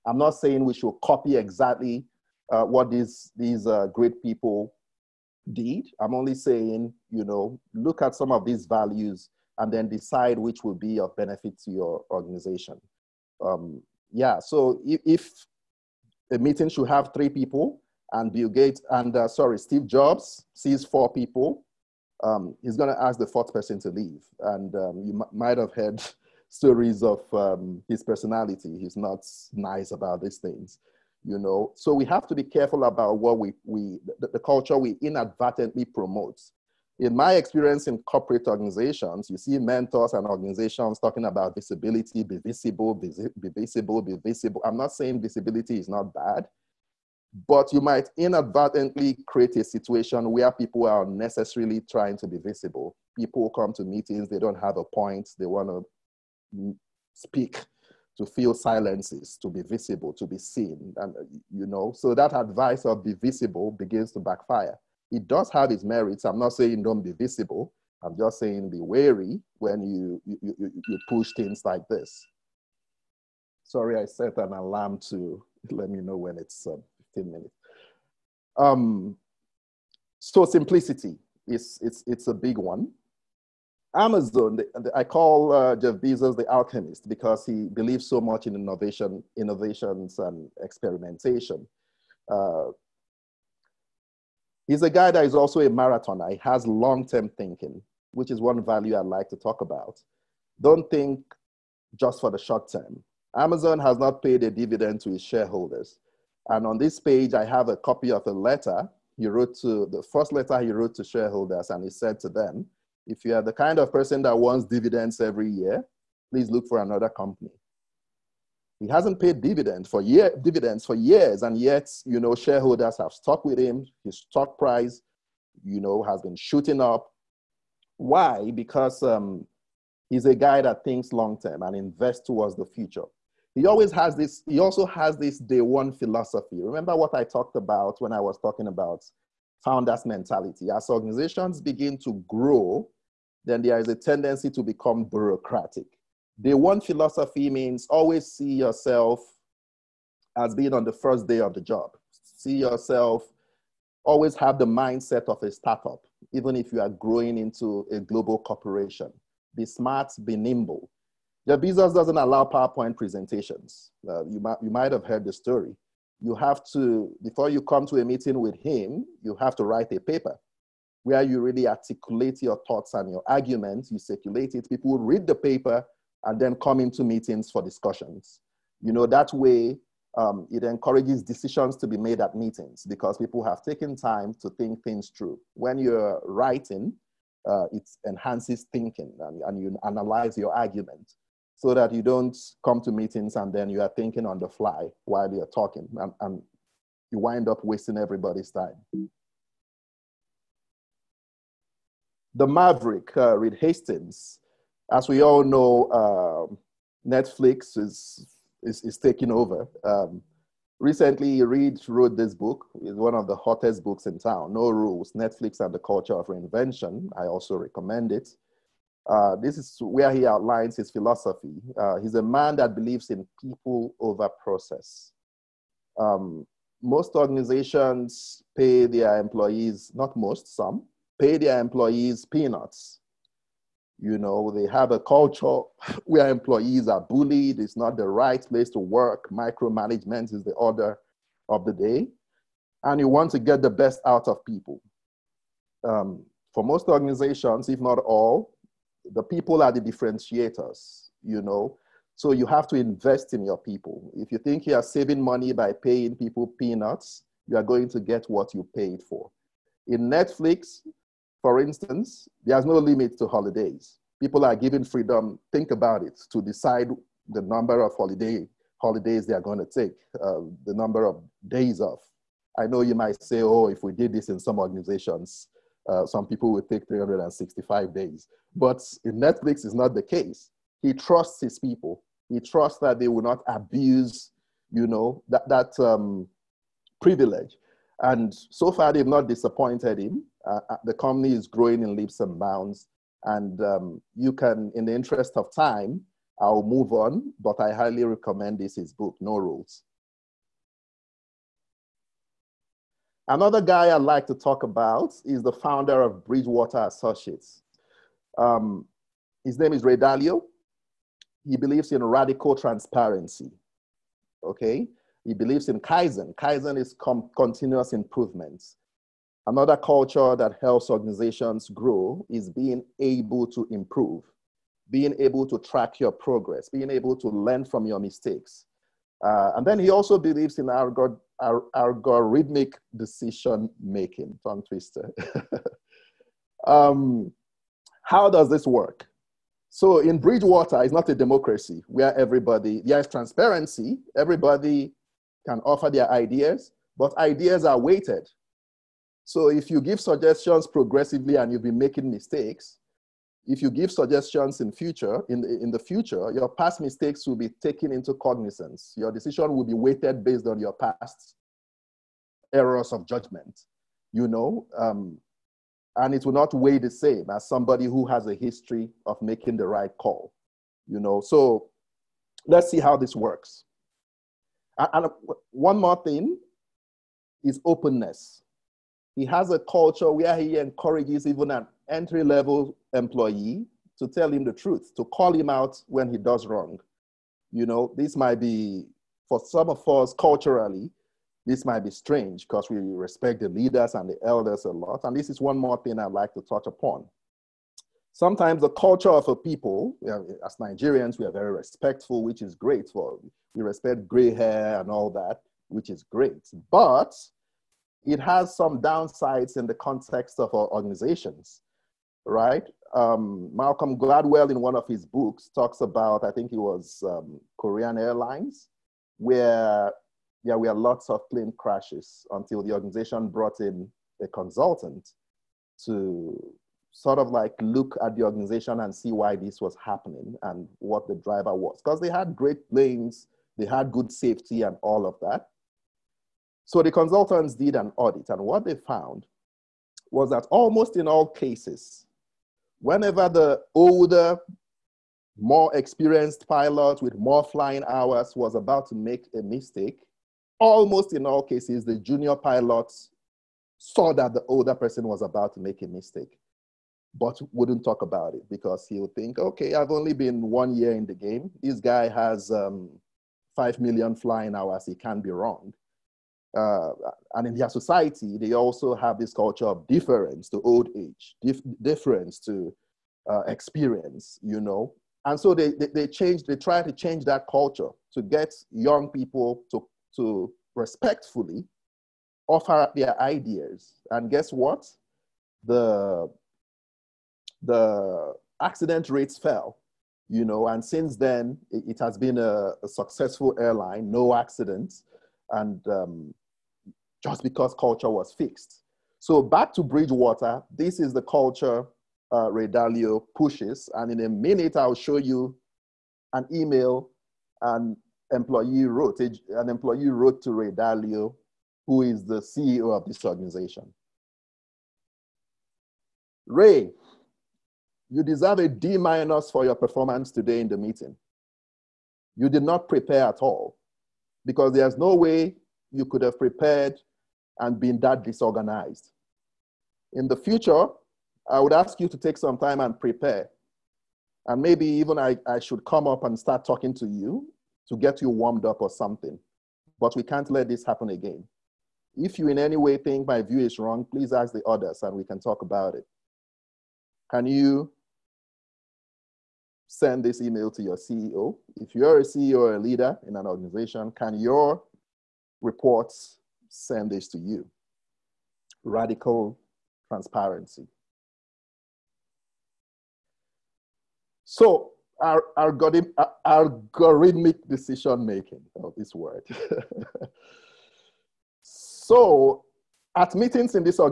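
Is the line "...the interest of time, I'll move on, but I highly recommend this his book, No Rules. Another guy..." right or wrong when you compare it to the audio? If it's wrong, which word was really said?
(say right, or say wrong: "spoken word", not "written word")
right.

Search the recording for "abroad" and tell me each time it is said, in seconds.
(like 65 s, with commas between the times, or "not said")
not said.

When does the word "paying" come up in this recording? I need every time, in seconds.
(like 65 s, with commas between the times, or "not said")
255 s.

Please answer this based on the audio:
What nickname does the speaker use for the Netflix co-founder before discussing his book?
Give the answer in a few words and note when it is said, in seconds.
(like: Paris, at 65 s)
The Maverick, at 202 s.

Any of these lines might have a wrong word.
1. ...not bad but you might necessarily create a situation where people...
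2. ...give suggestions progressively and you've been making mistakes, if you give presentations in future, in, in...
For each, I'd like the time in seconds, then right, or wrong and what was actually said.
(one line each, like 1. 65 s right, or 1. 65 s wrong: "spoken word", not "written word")
1. 45 s wrong: "inadvertently", not "necessarily"
2. 349 s wrong: "suggestions", not "presentations".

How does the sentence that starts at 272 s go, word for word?
I know you might say, oh, if we did this in some organizations, uh, some people will take 365 days.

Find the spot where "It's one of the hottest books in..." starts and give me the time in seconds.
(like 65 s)
212 s.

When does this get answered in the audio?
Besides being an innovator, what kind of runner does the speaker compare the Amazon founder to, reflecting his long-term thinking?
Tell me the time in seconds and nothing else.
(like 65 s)
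95 s.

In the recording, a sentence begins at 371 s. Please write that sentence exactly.
So let's see how this works.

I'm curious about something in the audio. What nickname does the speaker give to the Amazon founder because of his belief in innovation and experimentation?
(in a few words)
The alchemist.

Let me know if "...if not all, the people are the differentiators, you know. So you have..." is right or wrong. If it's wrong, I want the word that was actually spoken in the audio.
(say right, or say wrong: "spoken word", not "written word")
right.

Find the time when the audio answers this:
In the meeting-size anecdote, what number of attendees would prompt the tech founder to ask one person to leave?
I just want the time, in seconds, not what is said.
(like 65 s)
20 s.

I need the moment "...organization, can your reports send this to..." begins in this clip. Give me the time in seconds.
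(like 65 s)
553 s.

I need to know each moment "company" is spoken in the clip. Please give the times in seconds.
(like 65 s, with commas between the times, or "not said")
117 s, 290 s.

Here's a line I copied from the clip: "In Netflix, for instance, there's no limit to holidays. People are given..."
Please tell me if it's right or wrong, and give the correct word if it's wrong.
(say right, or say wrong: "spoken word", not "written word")
right.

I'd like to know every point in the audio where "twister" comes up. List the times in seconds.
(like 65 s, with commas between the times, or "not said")
334 s.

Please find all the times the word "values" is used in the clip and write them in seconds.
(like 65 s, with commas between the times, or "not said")
8 s, 98 s.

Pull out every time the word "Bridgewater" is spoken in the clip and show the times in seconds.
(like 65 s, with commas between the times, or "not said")
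306 s, 340 s, 499 s.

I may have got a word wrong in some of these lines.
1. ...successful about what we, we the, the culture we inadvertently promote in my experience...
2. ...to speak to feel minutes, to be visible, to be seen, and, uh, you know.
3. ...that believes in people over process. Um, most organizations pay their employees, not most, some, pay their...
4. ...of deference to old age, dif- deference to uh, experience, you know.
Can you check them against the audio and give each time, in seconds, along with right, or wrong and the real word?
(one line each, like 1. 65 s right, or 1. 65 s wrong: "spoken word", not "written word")
1. 32 s wrong: "careful", not "successful"
2. 56 s wrong: "silences", not "minutes"
3. 222 s right
4. 469 s right.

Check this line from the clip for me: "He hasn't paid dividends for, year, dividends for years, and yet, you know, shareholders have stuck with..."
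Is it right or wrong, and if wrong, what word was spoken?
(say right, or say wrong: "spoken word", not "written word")
right.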